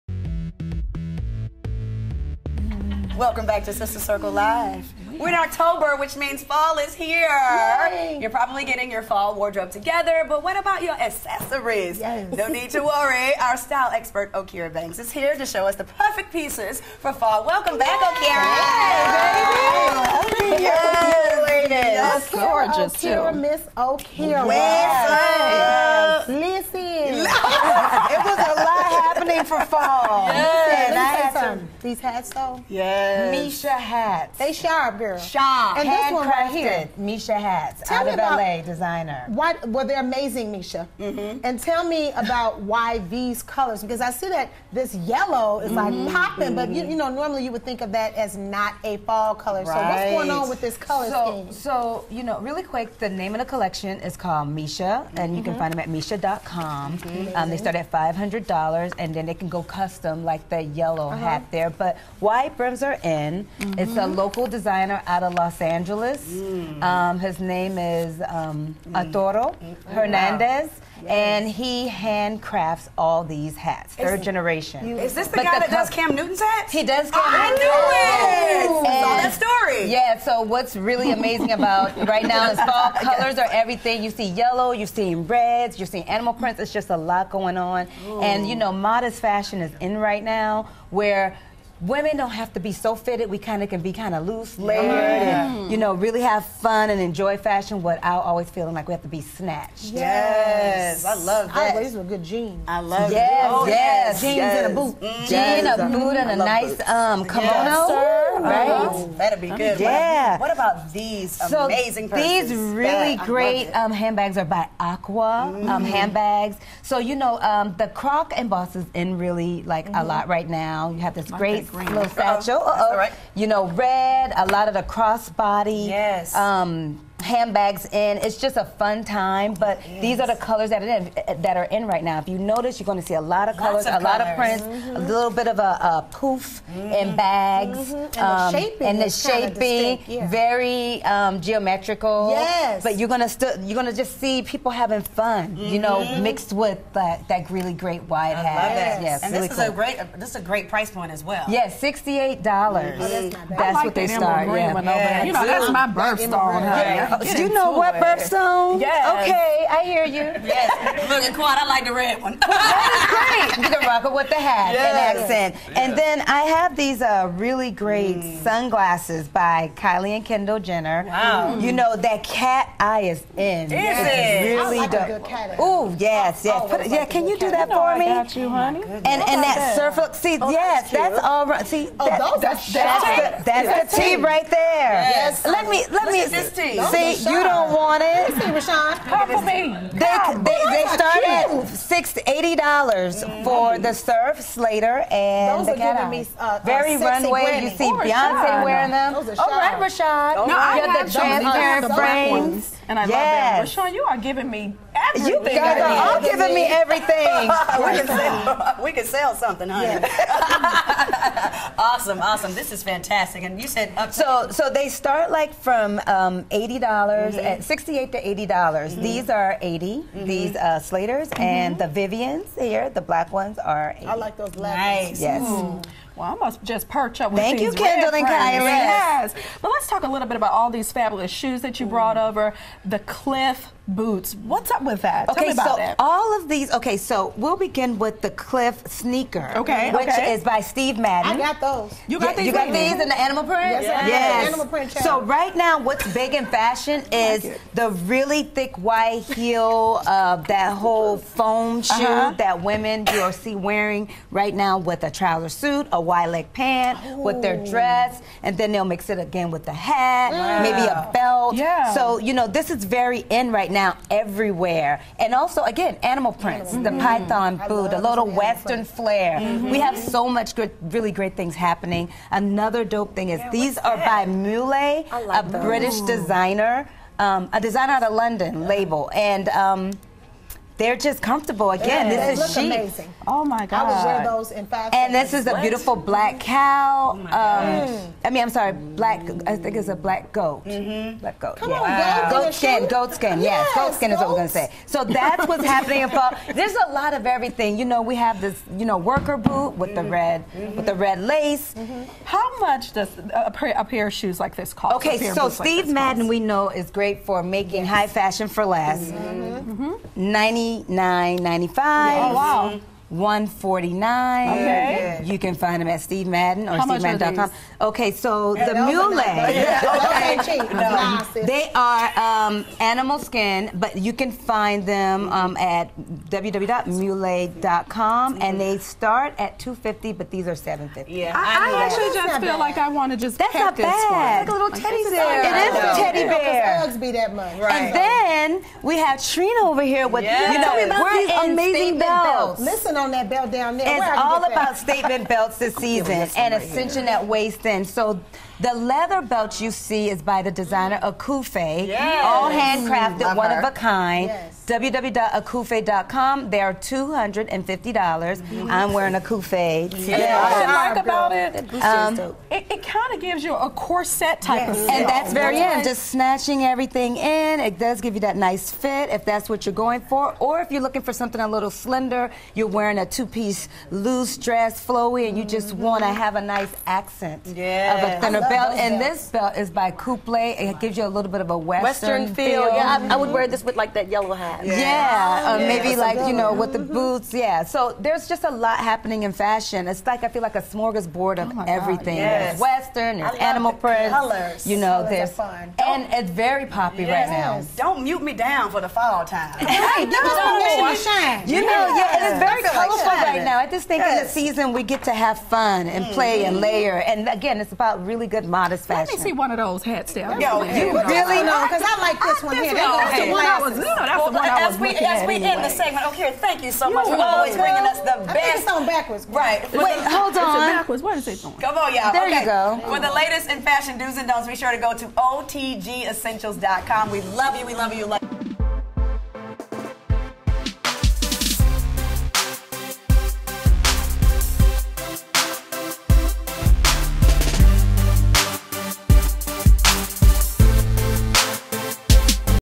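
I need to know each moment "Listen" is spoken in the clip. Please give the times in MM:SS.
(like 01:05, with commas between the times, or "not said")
00:26, 03:08, 05:42.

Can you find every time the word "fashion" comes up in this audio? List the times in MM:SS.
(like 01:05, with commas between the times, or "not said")
01:29, 01:37, 04:06, 05:08, 06:29, 06:48, 07:03.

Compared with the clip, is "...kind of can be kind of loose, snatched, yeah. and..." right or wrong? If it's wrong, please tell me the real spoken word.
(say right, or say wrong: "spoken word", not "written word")
wrong: "layered", not "snatched".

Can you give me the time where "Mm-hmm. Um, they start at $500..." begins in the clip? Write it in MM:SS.
00:56.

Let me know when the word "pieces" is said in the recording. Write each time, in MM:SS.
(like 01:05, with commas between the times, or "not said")
00:16, 06:13.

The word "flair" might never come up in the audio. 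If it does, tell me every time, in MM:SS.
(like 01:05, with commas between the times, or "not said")
04:28.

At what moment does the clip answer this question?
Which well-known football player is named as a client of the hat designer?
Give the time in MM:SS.
01:15.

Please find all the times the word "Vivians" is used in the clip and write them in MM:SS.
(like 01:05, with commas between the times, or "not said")
03:41.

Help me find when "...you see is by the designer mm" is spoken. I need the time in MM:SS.
05:49.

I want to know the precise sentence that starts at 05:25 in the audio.
um, at www.mule.com, and they mm-hmm.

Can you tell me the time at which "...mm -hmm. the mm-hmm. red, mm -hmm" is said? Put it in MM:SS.
04:59.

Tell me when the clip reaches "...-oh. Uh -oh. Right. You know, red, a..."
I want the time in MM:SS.
02:02.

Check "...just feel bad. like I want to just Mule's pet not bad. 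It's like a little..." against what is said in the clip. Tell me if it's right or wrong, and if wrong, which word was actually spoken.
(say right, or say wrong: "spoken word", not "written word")
wrong: "That", not "Mule".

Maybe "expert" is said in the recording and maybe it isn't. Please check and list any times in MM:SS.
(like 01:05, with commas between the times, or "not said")
00:13.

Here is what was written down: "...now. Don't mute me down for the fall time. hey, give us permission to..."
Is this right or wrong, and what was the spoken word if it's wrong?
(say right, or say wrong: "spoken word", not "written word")
right.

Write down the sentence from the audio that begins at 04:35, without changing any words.
British designer, um, a designer out of London, label.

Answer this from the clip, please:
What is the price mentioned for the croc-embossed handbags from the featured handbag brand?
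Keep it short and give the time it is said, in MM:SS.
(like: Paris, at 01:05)
$68, at 02:31.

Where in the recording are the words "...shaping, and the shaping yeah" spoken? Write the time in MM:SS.
02:18.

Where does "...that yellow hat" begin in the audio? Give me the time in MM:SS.
06:23.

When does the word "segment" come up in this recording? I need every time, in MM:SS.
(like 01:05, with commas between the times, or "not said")
06:55.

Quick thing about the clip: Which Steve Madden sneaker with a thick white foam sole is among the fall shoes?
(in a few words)
Cliff sneaker.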